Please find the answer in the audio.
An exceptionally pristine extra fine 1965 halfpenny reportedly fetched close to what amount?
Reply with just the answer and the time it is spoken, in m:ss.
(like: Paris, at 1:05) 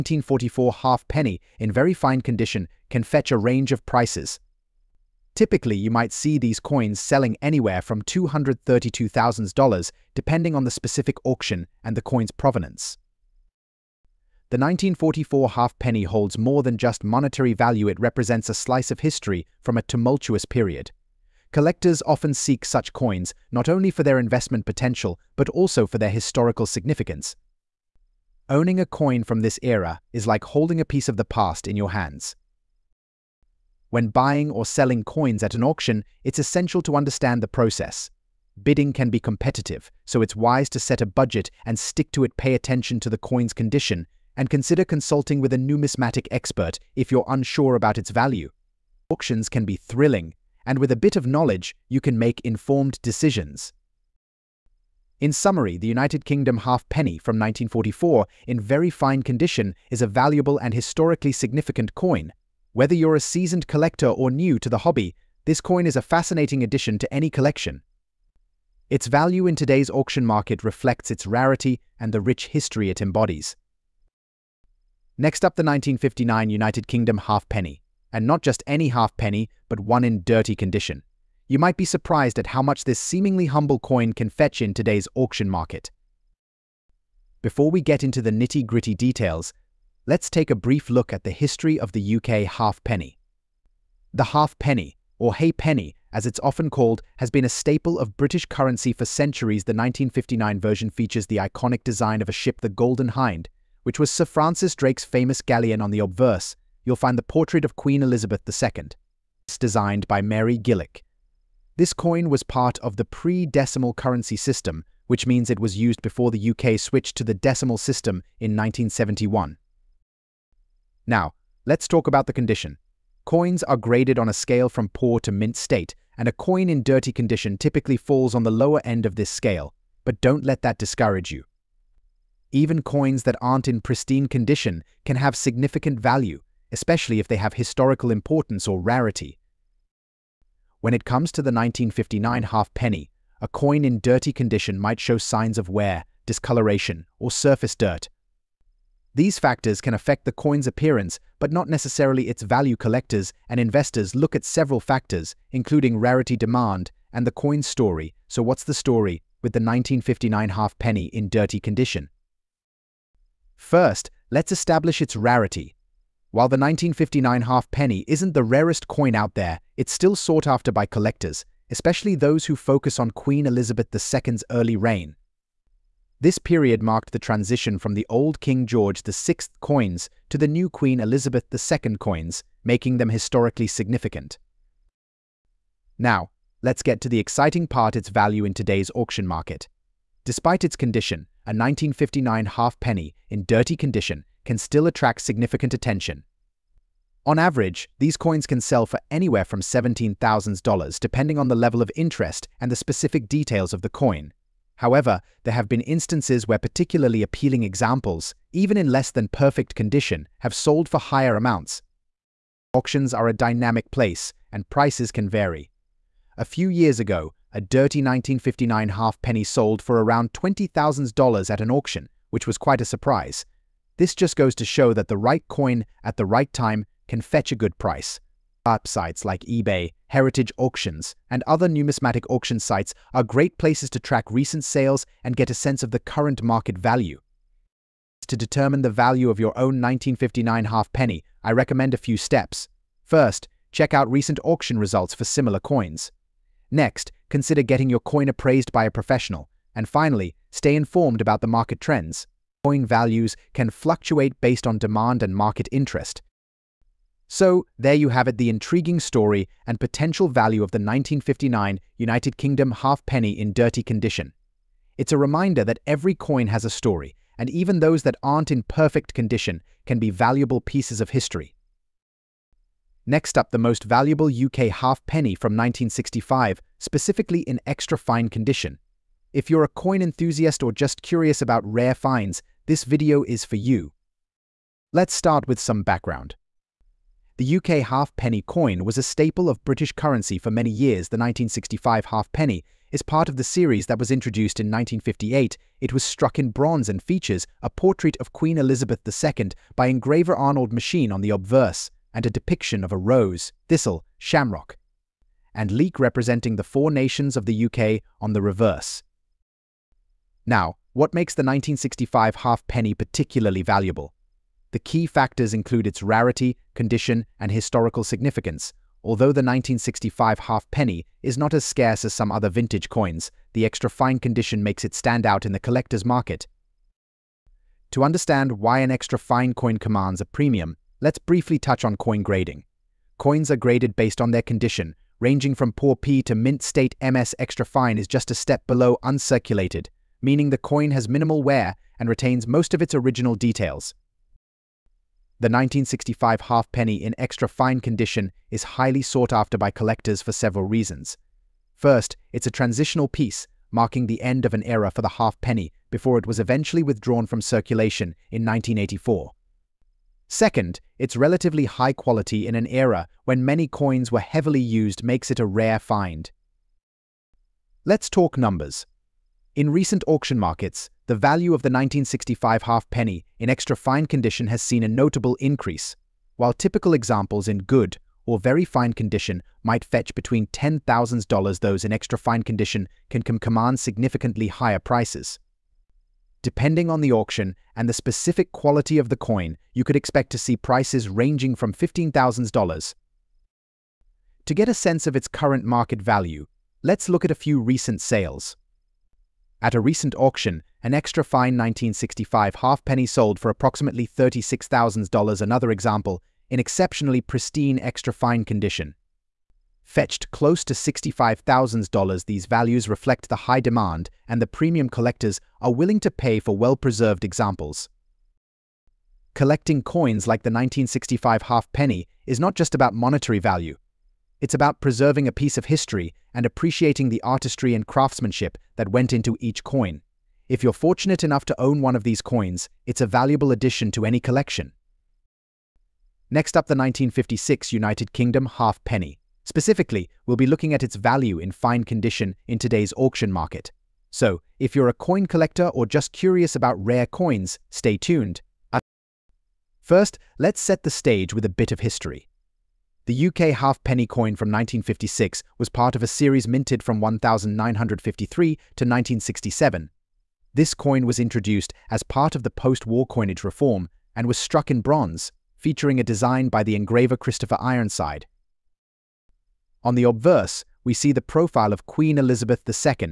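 $65,000, at 6:50.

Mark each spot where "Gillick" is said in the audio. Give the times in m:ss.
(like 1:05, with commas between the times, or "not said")
1:50.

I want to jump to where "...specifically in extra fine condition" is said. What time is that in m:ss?
4:36.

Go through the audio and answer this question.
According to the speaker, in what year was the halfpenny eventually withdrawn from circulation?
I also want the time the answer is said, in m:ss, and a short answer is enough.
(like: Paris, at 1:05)
1984, at 5:58.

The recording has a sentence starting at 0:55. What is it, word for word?
In summary, the United Kingdom halfpenny from 1944 in very fine condition is a valuable and historically significant coin.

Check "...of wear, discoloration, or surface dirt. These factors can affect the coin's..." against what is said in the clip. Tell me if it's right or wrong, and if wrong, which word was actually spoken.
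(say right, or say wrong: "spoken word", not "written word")
right.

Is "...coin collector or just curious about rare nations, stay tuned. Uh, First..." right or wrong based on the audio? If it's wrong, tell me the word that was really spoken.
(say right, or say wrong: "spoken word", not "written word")
wrong: "coins", not "nations".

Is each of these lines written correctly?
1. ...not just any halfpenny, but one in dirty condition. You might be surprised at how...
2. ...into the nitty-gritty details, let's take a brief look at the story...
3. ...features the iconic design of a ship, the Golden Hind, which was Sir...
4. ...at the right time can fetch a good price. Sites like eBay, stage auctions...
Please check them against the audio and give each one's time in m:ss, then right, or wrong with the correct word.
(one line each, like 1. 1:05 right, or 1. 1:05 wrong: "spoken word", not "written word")
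1. 1:18 right
2. 1:28 wrong: "history", not "story"
3. 1:40 right
4. 3:46 wrong: "heritage", not "stage".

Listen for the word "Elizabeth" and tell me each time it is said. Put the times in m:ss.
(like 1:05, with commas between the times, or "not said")
1:48, 2:53, 3:00, 4:58, 7:52.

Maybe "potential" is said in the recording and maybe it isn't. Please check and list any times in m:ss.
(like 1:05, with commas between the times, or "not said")
0:24, 4:19.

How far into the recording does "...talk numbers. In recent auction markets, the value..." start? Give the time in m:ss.
6:08.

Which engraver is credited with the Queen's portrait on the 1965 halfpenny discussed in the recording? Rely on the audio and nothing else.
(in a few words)
Arnold Machin.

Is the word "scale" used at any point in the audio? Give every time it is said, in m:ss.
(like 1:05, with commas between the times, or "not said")
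2:04, 2:09.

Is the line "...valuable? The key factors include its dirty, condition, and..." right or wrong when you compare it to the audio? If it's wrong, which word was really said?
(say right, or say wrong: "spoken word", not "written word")
wrong: "rarity", not "dirty".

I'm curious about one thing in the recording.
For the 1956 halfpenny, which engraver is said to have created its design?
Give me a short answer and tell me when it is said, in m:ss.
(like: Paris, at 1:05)
Christopher Ironside, at 7:47.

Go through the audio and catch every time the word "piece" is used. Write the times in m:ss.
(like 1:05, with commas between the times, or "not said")
0:30, 4:30, 5:53, 7:05.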